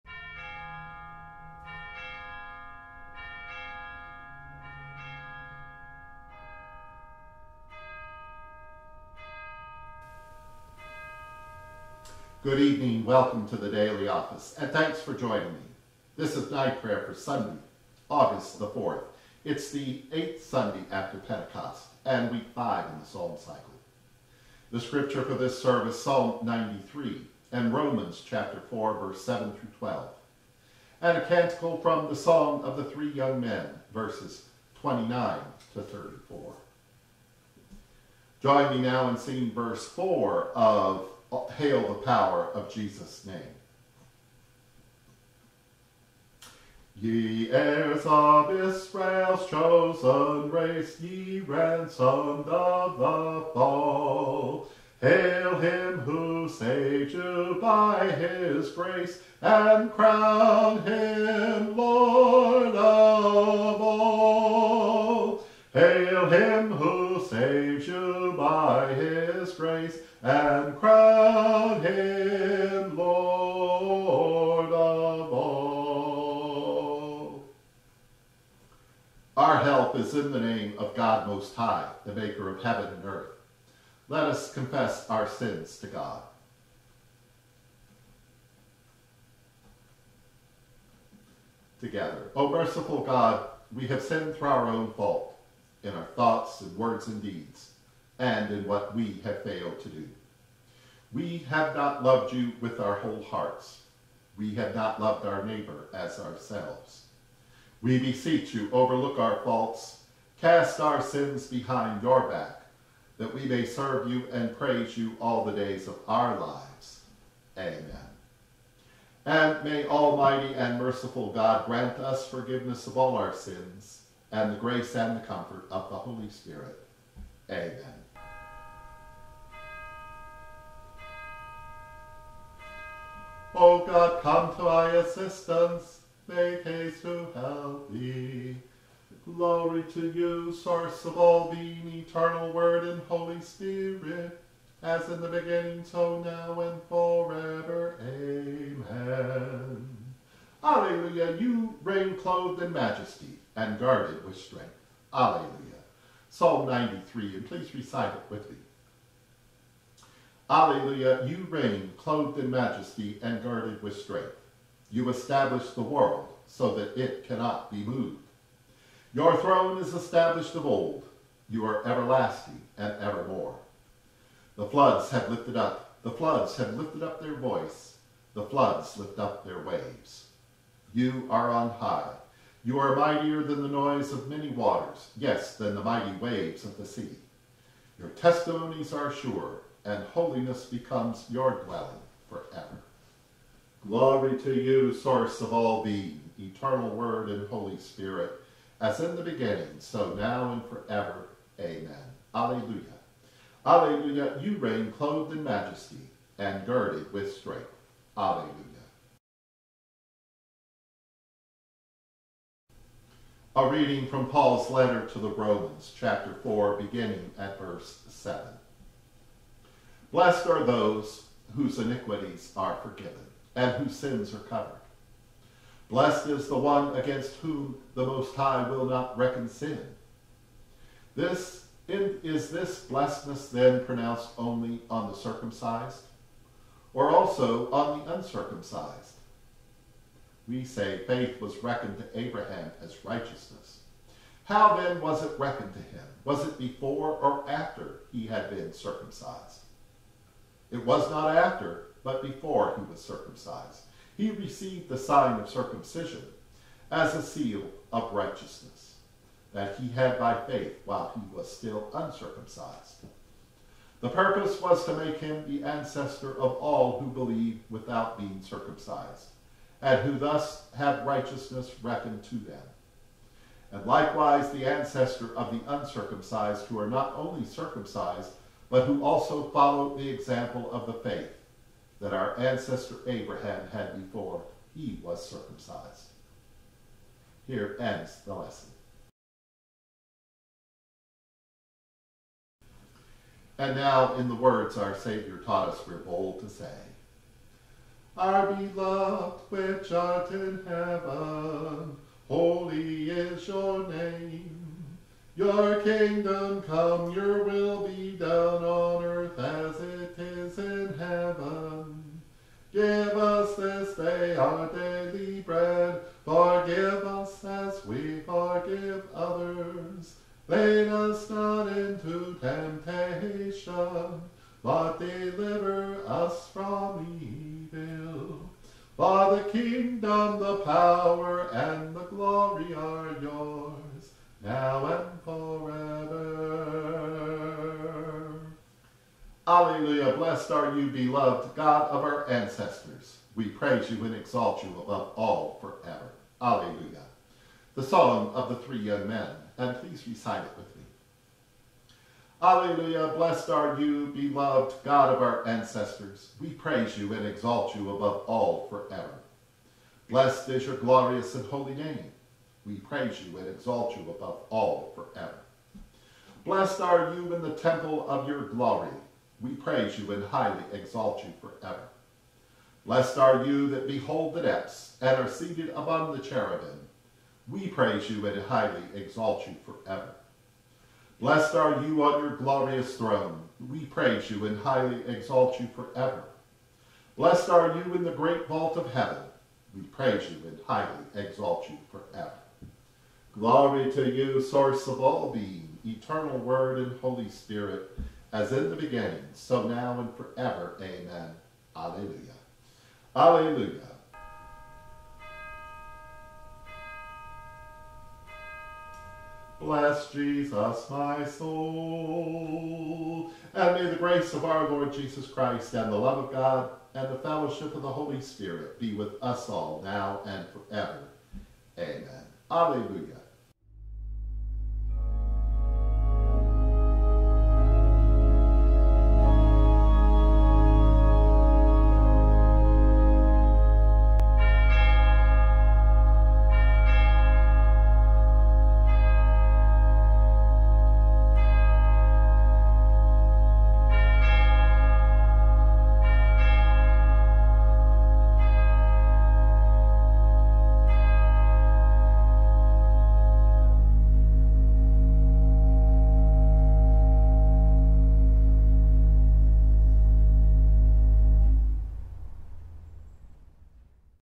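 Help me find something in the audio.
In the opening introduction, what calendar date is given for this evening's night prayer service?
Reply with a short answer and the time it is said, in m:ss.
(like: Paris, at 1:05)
Sunday, August 4, at 0:17.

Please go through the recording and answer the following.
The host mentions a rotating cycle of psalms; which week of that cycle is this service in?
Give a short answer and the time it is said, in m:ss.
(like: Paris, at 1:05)
Week five, at 0:22.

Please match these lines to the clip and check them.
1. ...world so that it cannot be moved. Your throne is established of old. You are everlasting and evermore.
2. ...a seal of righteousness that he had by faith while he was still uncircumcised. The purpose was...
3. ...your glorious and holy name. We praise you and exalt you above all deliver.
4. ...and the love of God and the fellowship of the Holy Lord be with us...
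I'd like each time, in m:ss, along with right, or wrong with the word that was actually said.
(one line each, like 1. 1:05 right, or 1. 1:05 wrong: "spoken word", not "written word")
1. 2:45 right
2. 4:17 right
3. 6:00 wrong: "forever", not "deliver"
4. 6:55 wrong: "Spirit", not "Lord".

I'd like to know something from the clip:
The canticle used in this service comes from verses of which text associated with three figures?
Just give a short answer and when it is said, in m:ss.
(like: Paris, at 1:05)
Song of the Three Young Men, at 0:32.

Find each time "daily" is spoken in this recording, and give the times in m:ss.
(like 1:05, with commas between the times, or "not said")
0:13, 5:14.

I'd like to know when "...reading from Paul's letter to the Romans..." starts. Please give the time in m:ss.
3:33.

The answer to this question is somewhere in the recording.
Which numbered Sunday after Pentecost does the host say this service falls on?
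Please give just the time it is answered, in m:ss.
0:20.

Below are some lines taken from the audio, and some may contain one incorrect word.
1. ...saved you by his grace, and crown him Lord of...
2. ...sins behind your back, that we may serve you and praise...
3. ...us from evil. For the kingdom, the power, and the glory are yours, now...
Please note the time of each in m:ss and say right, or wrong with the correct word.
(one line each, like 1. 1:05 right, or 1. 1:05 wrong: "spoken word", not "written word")
1. 0:56 right
2. 1:51 right
3. 5:26 right.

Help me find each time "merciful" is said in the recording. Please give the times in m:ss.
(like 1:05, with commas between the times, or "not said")
1:32, 2:00.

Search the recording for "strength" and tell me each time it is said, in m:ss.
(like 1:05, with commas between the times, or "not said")
2:34, 2:43, 3:27.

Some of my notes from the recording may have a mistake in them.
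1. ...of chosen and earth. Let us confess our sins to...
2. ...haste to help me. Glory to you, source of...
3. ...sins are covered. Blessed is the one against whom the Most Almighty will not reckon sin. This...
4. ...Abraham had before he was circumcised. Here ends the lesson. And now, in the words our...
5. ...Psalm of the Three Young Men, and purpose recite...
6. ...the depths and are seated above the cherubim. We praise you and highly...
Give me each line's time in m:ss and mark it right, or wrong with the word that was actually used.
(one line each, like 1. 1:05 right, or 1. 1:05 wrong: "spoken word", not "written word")
1. 1:22 wrong: "heaven", not "chosen"
2. 2:16 right
3. 3:43 wrong: "High", not "Almighty"
4. 4:43 right
5. 5:47 wrong: "please", not "purpose"
6. 6:14 right.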